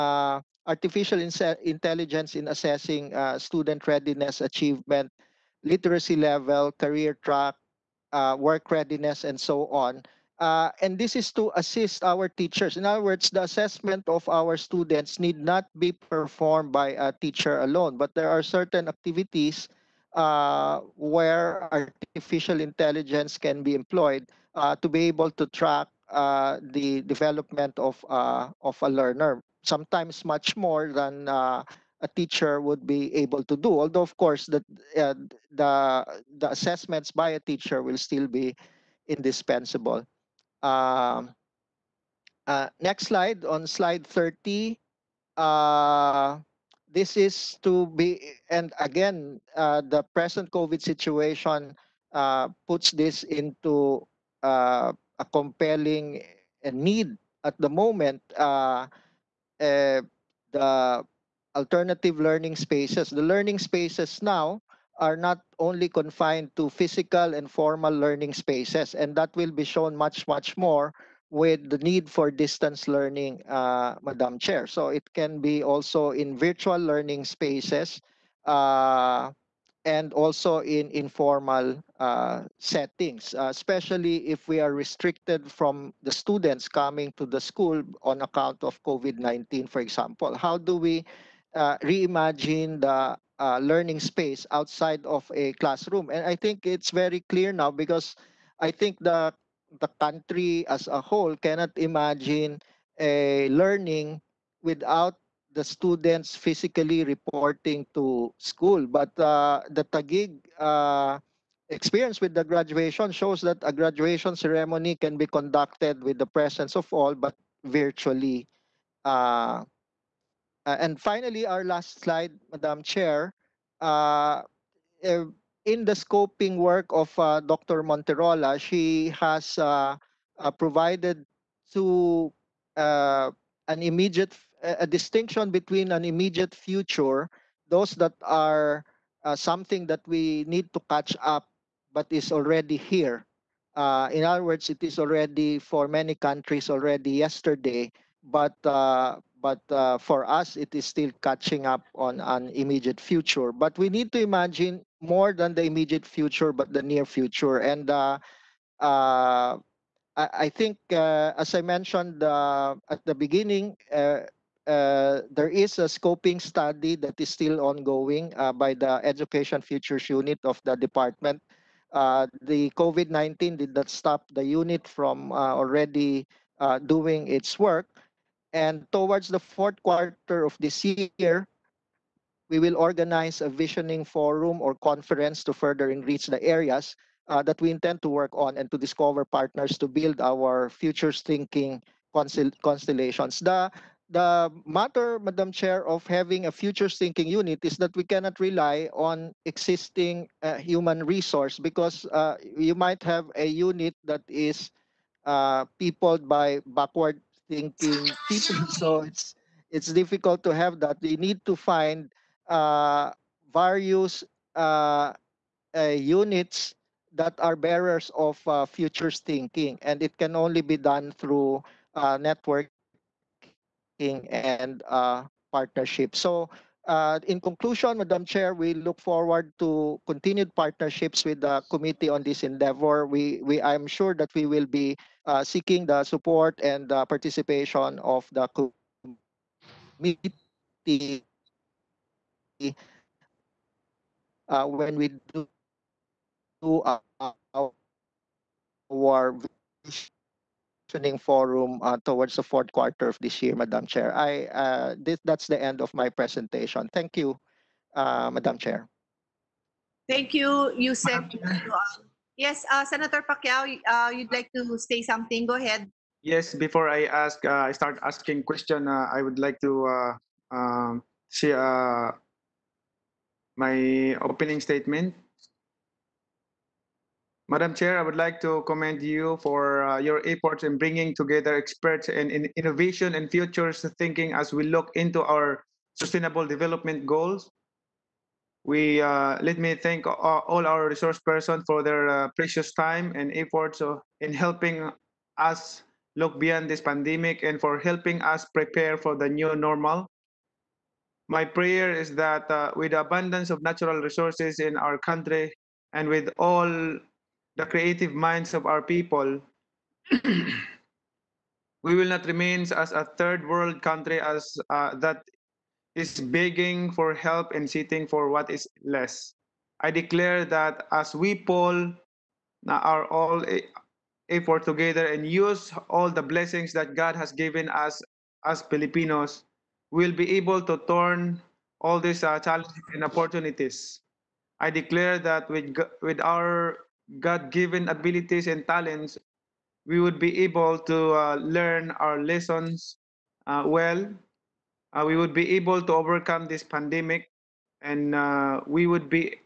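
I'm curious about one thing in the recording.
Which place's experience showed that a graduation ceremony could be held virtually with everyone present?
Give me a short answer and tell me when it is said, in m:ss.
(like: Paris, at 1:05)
Taguig, at 1:49.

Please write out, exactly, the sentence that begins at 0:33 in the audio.
Although, of course, the, uh, the, the assessments by a teacher will still be indispensable.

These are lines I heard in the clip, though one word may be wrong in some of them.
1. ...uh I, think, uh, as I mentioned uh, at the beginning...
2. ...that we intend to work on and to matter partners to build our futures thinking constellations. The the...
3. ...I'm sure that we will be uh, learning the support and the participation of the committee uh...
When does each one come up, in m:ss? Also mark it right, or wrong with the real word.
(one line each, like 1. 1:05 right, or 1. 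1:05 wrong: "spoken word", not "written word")
1. 2:38 right
2. 3:07 wrong: "discover", not "matter"
3. 3:53 wrong: "seeking", not "learning".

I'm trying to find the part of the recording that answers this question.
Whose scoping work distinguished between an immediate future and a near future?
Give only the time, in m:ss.
2:07.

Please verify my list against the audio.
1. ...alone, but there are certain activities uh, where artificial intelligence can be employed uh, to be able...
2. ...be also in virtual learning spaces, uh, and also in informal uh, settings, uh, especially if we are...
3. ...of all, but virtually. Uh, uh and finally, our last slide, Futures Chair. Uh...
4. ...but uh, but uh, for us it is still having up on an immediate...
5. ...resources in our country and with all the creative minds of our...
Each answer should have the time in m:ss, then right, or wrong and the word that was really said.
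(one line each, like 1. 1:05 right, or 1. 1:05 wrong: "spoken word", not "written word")
1. 0:17 right
2. 1:15 right
3. 1:56 wrong: "Madam", not "Futures"
4. 2:28 wrong: "catching", not "having"
5. 5:03 right.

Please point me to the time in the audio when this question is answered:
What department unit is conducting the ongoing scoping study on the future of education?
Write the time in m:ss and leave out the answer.
2:49.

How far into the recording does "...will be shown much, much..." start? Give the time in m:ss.
1:09.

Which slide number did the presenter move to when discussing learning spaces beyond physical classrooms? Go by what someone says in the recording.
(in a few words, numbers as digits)
30.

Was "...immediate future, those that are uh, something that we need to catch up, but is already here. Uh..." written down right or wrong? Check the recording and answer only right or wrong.
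right.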